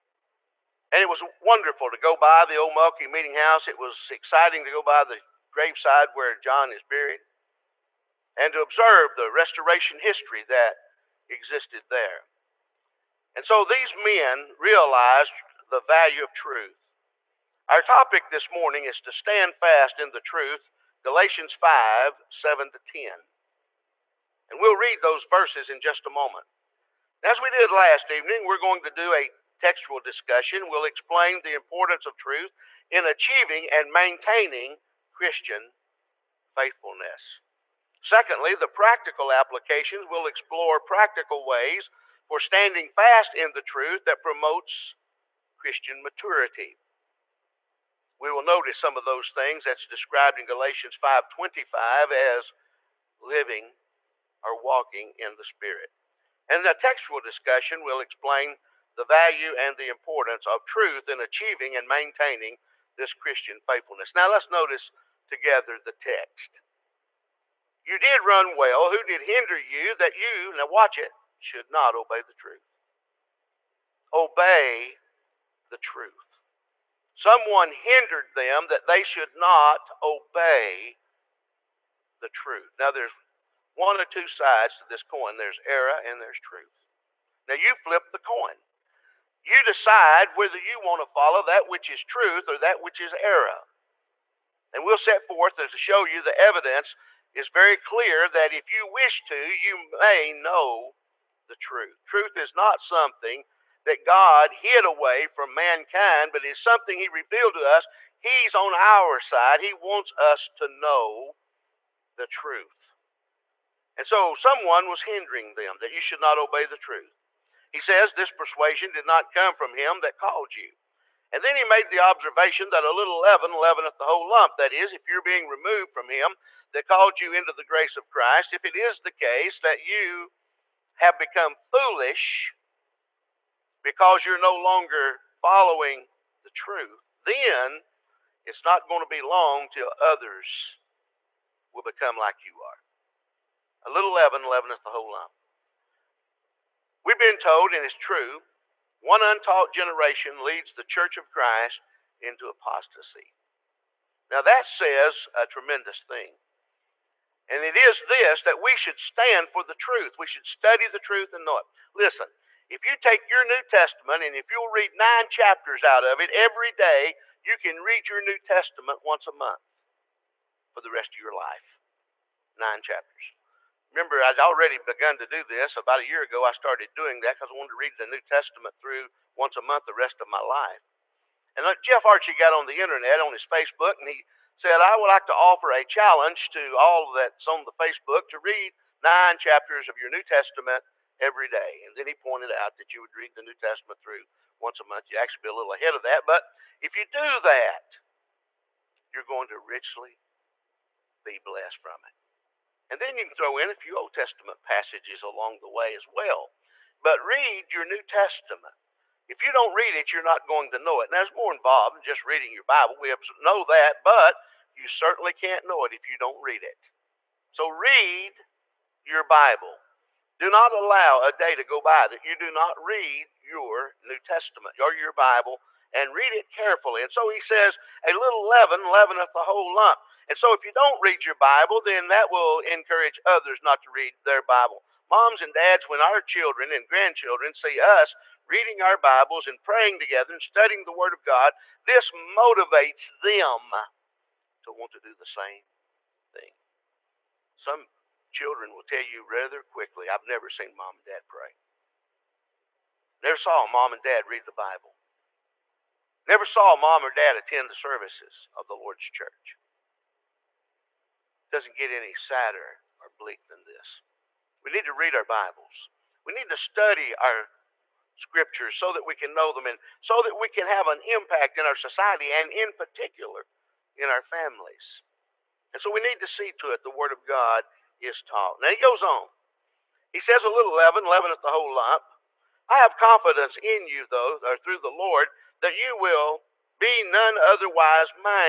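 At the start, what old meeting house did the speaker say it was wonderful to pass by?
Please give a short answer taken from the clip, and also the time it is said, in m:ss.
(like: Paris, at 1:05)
Mulkey meeting house, at 0:02.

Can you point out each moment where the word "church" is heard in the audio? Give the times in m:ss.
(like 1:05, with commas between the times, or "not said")
2:30, 4:19.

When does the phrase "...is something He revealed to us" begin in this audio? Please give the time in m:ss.
1:46.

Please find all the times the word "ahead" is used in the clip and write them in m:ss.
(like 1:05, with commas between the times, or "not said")
3:15.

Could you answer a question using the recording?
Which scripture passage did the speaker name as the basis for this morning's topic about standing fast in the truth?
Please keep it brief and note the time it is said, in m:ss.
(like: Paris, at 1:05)
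Galatians 5:7-10, at 0:21.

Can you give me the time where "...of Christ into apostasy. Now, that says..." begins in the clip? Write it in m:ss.
2:31.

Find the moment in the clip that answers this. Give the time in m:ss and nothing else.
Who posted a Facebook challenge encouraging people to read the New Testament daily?
3:01.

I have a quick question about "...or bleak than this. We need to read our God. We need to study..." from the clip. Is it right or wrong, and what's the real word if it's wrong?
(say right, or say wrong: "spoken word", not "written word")
wrong: "Bibles", not "God".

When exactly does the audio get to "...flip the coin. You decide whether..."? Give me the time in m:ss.
1:27.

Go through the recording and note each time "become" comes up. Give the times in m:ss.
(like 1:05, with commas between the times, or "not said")
2:11, 2:21.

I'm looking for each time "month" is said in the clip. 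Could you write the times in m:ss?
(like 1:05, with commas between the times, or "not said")
2:49, 2:59, 3:14.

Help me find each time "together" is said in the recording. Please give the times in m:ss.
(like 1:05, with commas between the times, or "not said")
1:05, 3:59.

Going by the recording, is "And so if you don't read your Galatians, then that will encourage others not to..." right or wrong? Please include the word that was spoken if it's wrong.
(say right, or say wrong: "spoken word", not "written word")
wrong: "Bible", not "Galatians".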